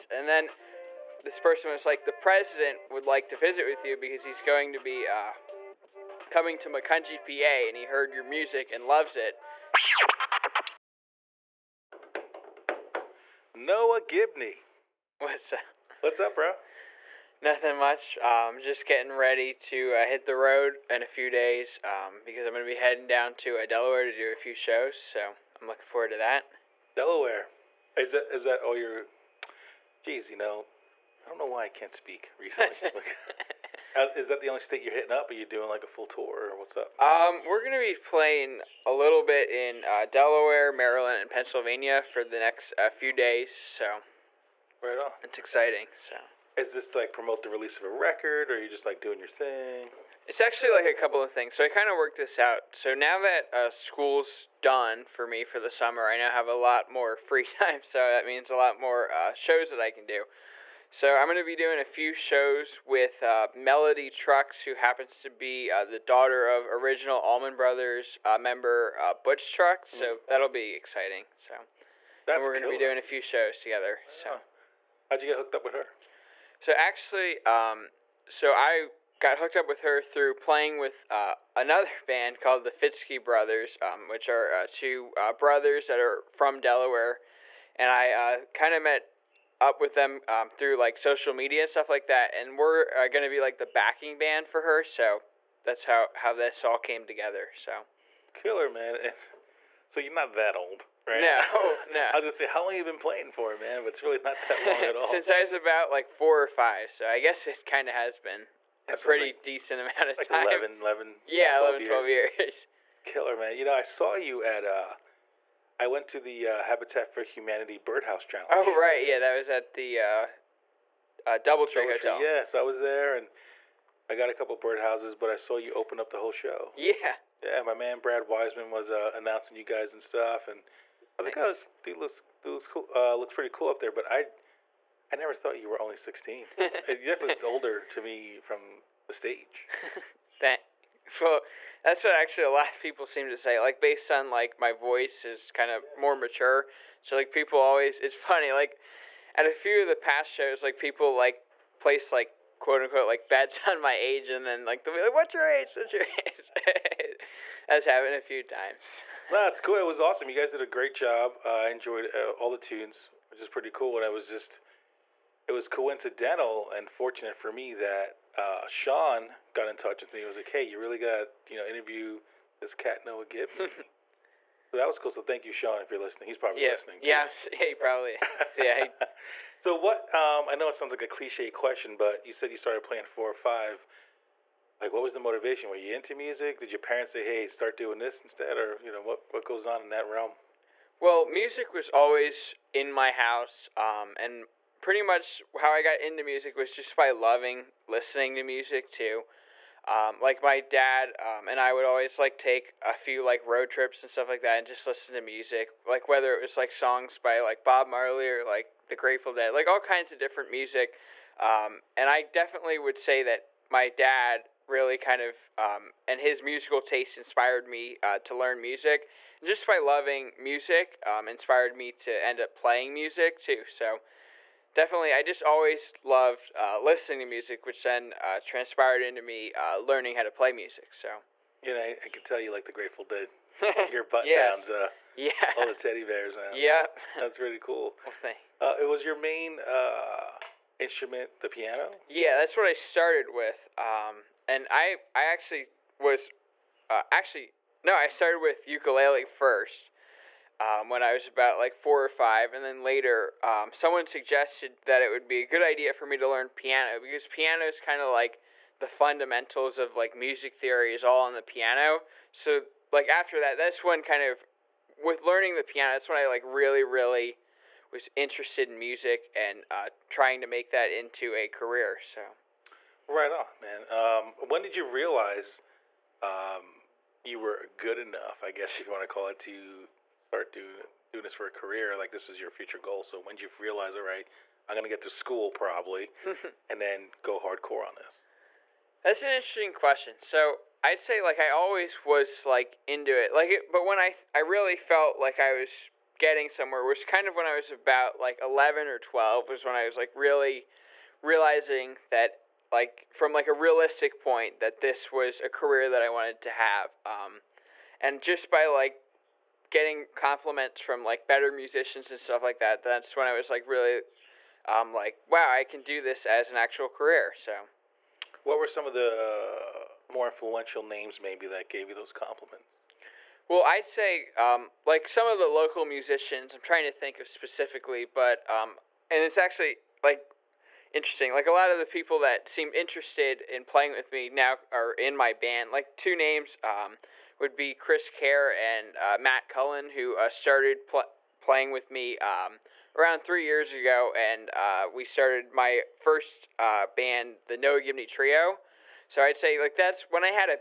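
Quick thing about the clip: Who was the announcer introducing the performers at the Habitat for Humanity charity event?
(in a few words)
Brad Wiseman.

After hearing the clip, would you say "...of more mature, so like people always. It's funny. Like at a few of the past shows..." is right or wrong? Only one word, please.
right.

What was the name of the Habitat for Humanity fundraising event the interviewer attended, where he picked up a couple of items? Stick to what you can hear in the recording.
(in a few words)
Birdhouse Challenge.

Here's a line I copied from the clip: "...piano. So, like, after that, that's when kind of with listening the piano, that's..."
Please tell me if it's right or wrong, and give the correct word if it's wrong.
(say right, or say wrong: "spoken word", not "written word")
wrong: "learning", not "listening".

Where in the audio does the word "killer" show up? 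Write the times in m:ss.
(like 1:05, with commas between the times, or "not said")
1:38, 1:53.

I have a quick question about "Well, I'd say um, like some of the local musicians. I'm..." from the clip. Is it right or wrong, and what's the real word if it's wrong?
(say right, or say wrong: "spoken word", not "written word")
right.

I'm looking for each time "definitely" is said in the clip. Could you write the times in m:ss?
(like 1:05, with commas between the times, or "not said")
2:17, 3:32, 3:44.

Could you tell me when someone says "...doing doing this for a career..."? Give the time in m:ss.
4:40.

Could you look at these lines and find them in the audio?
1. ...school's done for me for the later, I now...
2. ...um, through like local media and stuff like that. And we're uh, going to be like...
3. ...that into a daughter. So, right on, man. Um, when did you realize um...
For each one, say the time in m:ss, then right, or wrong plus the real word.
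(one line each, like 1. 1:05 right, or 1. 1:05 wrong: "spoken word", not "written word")
1. 0:53 wrong: "summer", not "later"
2. 1:30 wrong: "social", not "local"
3. 4:30 wrong: "career", not "daughter".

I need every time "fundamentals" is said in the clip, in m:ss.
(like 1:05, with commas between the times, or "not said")
4:18.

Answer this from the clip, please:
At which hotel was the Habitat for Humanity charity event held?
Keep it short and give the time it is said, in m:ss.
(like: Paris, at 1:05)
DoubleTree Hotel, at 2:01.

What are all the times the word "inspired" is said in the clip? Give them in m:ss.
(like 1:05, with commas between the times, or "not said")
3:37, 3:41.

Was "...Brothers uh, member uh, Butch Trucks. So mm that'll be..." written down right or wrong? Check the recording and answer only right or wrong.
right.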